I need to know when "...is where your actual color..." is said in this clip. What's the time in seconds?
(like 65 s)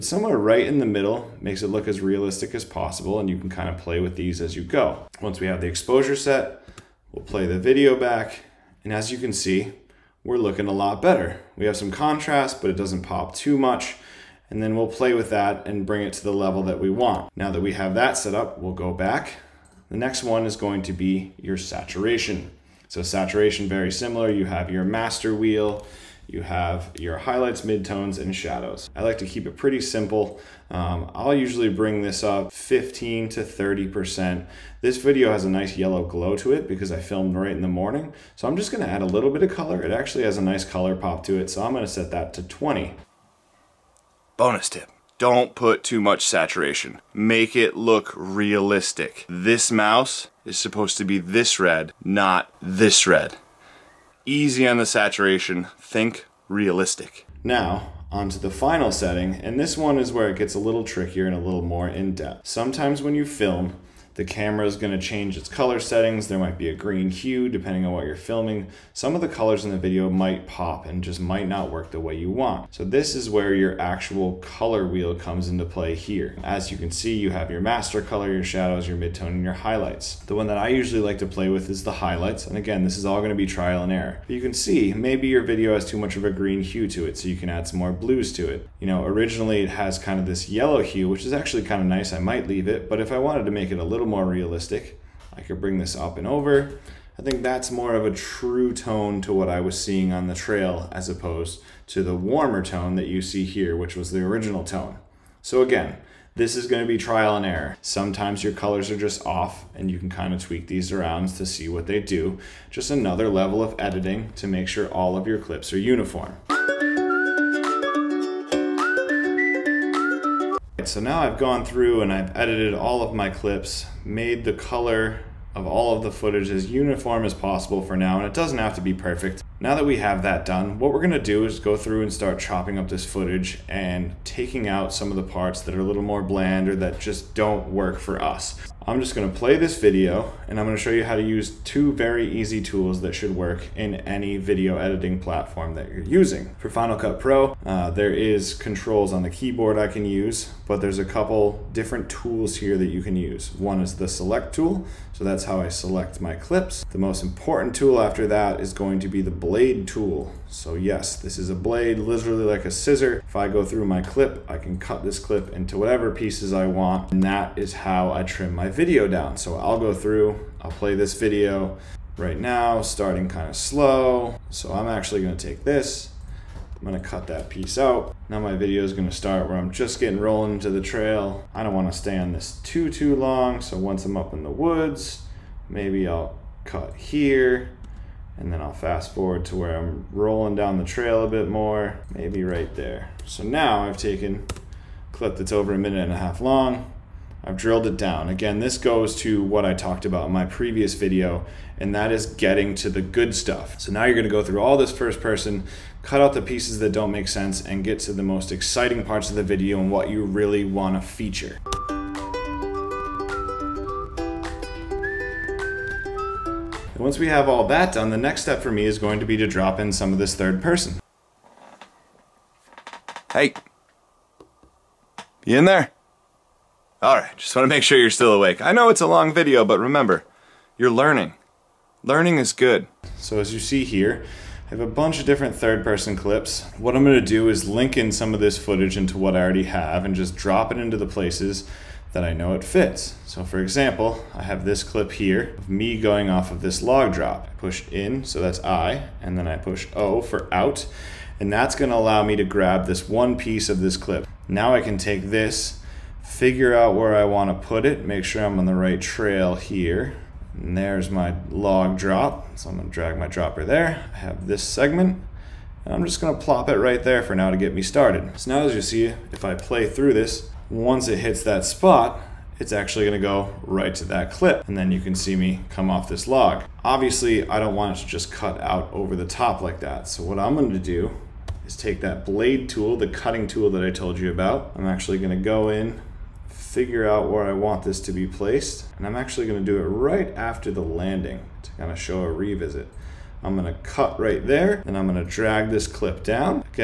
73 s.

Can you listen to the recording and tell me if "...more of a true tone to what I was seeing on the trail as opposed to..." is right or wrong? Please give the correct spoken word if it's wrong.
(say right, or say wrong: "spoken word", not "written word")
right.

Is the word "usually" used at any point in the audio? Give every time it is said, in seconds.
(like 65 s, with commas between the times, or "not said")
31 s, 80 s.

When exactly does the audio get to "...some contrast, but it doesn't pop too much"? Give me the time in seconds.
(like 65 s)
11 s.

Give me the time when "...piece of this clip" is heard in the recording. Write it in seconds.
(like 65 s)
253 s.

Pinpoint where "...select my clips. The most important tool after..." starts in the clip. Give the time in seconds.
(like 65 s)
155 s.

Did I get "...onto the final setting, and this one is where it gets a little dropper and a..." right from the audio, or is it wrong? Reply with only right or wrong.
wrong.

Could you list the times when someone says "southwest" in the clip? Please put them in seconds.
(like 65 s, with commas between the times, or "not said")
not said.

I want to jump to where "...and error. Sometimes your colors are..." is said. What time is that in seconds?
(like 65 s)
107 s.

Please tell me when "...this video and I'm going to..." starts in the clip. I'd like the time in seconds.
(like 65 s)
139 s.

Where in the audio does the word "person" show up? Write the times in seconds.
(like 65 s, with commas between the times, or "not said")
205 s, 220 s, 235 s.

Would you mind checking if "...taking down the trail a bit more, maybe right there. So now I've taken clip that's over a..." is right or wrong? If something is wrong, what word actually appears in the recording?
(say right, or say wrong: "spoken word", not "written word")
wrong: "rolling", not "taking".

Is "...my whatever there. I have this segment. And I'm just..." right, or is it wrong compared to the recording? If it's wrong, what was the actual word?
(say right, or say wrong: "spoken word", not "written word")
wrong: "dropper", not "whatever".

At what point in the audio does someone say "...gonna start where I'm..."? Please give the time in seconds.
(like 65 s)
178 s.